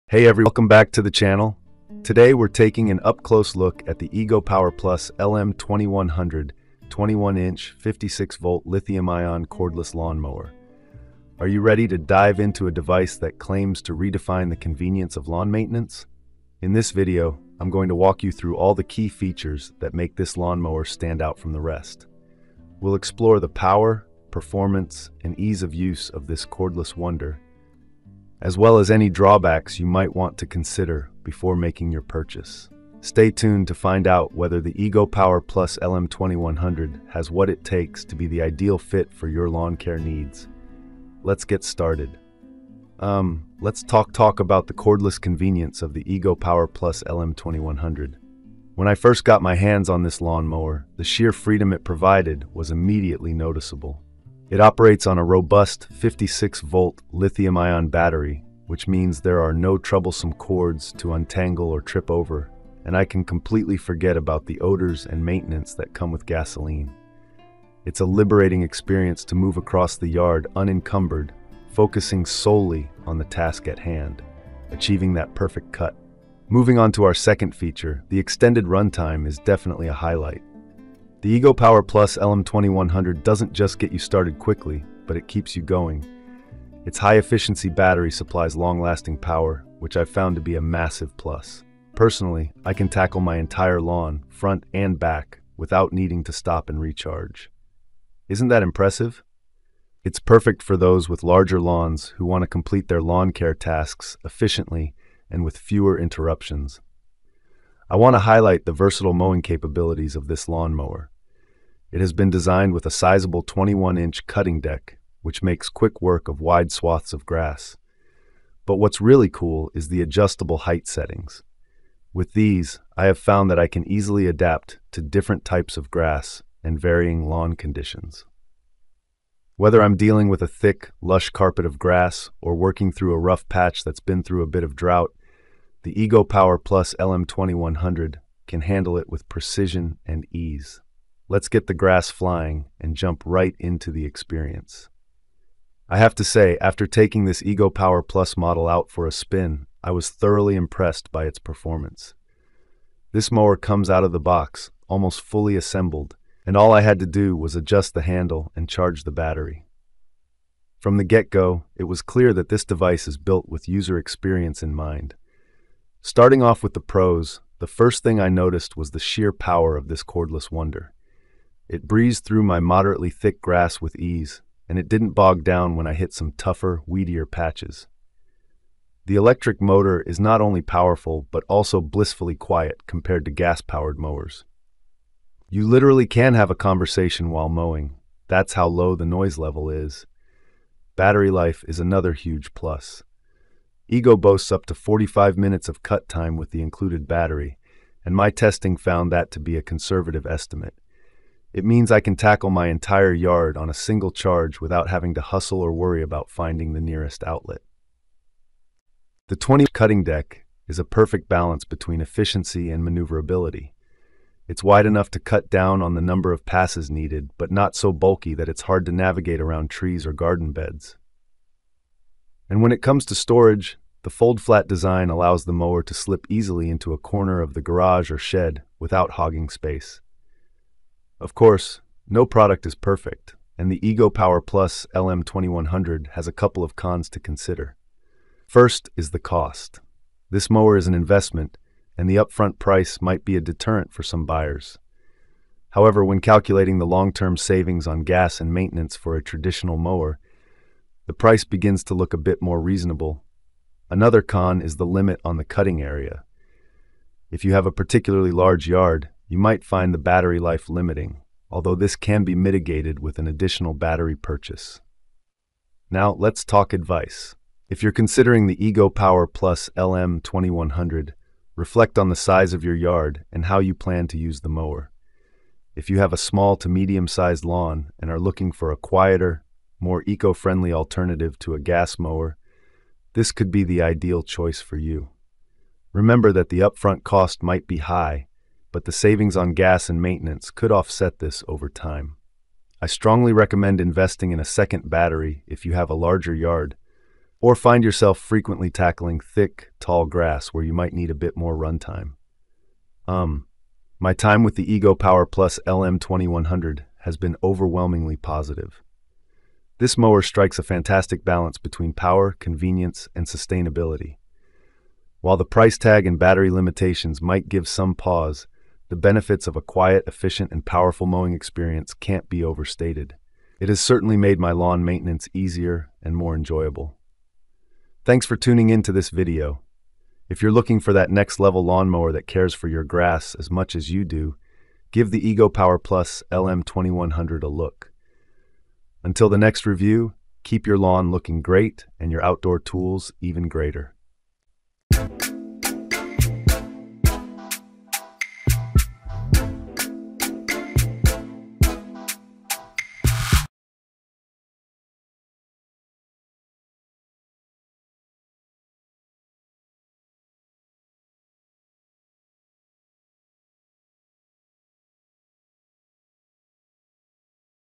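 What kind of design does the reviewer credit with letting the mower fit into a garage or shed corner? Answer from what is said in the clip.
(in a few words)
fold flat design.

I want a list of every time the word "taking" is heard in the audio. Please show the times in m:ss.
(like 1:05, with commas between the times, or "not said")
0:02, 2:26.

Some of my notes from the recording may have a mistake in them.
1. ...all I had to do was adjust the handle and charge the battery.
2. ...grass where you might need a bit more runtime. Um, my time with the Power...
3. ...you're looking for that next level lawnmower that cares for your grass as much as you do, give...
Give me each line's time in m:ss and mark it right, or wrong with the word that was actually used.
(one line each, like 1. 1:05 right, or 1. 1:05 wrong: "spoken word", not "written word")
1. 2:36 right
2. 5:00 wrong: "Ego", not "Power"
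3. 5:30 right.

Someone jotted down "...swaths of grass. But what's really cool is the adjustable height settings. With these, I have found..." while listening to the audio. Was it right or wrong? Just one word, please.
right.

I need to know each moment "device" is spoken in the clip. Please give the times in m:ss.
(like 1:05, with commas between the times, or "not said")
0:12, 2:42.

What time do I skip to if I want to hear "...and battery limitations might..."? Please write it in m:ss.
5:16.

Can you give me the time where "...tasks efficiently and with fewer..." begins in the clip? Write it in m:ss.
1:43.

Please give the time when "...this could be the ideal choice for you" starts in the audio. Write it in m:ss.
4:43.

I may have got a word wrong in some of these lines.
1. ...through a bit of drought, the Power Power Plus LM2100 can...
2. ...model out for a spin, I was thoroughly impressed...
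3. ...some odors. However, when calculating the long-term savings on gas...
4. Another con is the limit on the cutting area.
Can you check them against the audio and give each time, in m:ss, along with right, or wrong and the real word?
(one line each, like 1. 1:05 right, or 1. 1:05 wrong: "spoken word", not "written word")
1. 2:14 wrong: "Ego", not "Power"
2. 2:28 right
3. 4:04 wrong: "buyers", not "odors"
4. 4:13 right.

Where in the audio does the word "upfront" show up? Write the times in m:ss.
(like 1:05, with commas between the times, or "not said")
4:02, 4:46.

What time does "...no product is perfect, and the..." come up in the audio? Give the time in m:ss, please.
3:52.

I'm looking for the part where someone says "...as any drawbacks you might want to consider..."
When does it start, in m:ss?
0:28.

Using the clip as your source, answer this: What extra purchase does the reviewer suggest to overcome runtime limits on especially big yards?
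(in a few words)
additional battery.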